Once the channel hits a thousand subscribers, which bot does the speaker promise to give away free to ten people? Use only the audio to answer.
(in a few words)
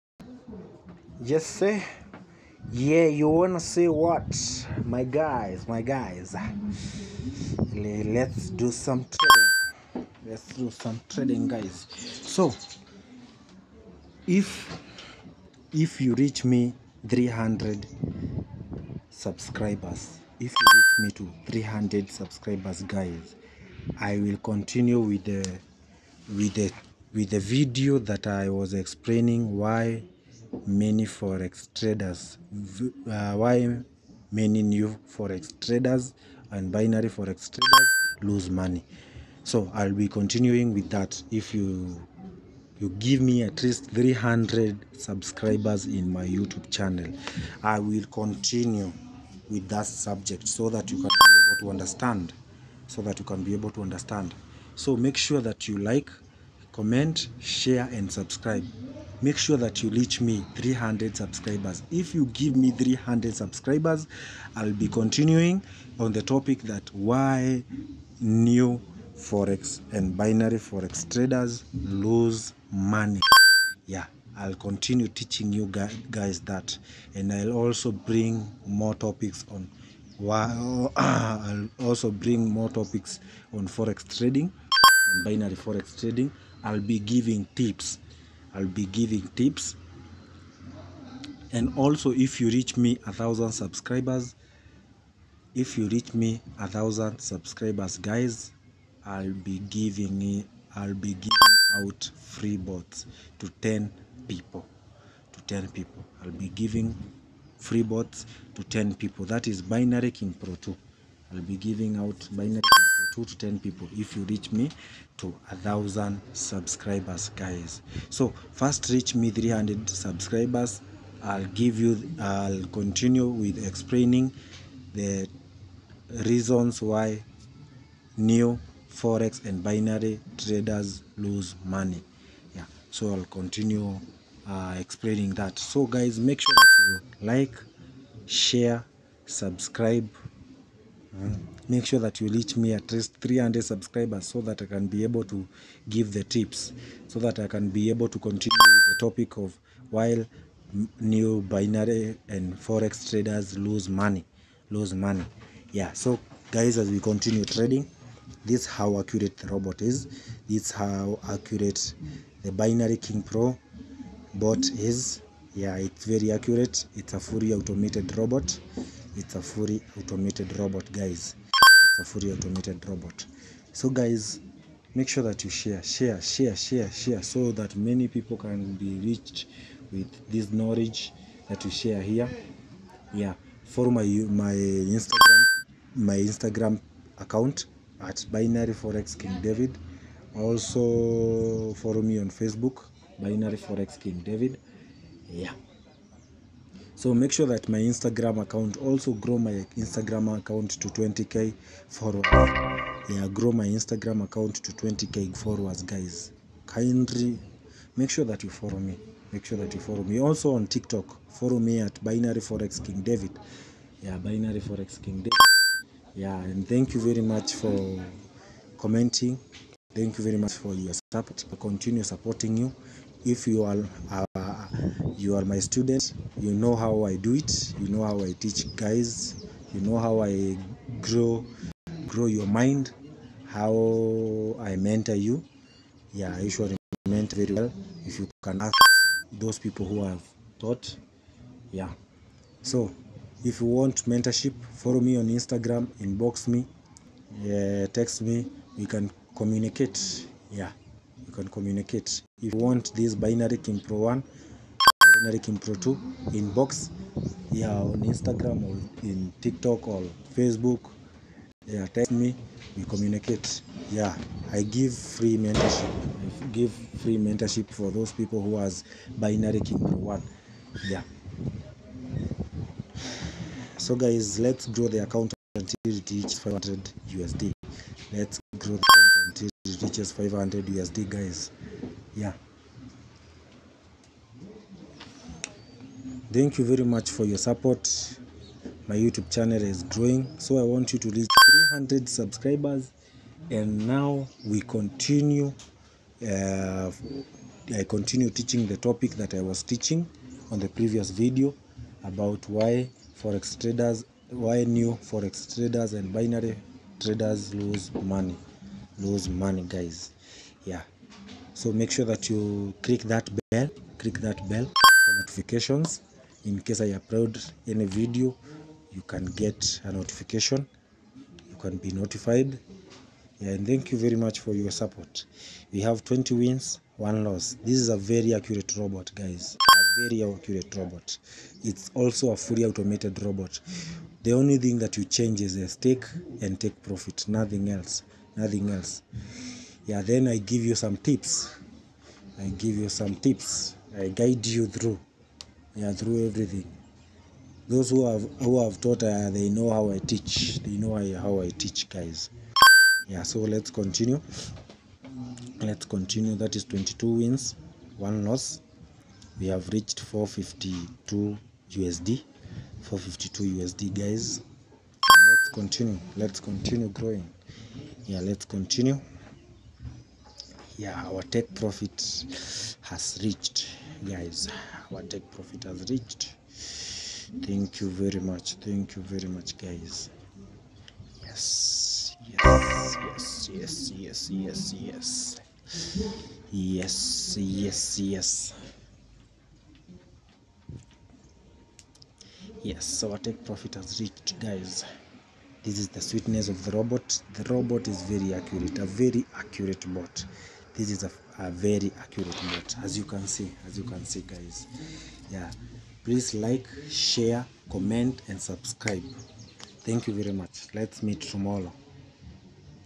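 Binary King Pro 2.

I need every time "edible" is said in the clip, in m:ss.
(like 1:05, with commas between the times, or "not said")
not said.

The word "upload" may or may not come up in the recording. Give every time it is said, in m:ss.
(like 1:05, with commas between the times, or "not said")
5:16.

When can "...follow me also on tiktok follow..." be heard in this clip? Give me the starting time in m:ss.
3:29.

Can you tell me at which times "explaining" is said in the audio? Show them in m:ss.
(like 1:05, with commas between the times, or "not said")
0:28, 2:03, 2:14.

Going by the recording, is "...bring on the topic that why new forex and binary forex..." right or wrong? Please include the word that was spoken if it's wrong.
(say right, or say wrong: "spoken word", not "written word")
wrong: "continuing", not "bring".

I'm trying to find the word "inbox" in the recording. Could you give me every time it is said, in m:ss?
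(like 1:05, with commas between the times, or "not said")
4:06, 4:16.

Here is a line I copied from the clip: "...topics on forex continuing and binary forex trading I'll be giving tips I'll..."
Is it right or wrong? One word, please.
wrong.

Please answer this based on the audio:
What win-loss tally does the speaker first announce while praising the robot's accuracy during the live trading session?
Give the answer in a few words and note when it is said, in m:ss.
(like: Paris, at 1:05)
20 wins, 1 loss, at 5:26.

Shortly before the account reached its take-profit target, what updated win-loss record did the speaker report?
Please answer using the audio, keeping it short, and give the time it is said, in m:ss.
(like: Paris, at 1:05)
22 wins, 1 loss, at 5:56.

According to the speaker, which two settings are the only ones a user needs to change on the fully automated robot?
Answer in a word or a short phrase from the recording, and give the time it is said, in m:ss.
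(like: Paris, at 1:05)
Stake and take profit, at 5:35.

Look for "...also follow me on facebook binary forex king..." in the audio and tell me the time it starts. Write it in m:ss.
3:10.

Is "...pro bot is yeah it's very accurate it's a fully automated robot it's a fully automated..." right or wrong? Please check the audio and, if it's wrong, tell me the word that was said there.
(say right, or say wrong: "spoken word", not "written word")
right.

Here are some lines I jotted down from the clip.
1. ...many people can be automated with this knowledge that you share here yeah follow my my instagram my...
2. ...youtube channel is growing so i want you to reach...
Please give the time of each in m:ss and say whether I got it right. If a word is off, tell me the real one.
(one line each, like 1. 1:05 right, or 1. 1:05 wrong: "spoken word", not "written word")
1. 2:57 wrong: "reached", not "automated"
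2. 4:48 right.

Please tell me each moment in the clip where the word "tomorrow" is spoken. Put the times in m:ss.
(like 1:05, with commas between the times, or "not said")
6:51.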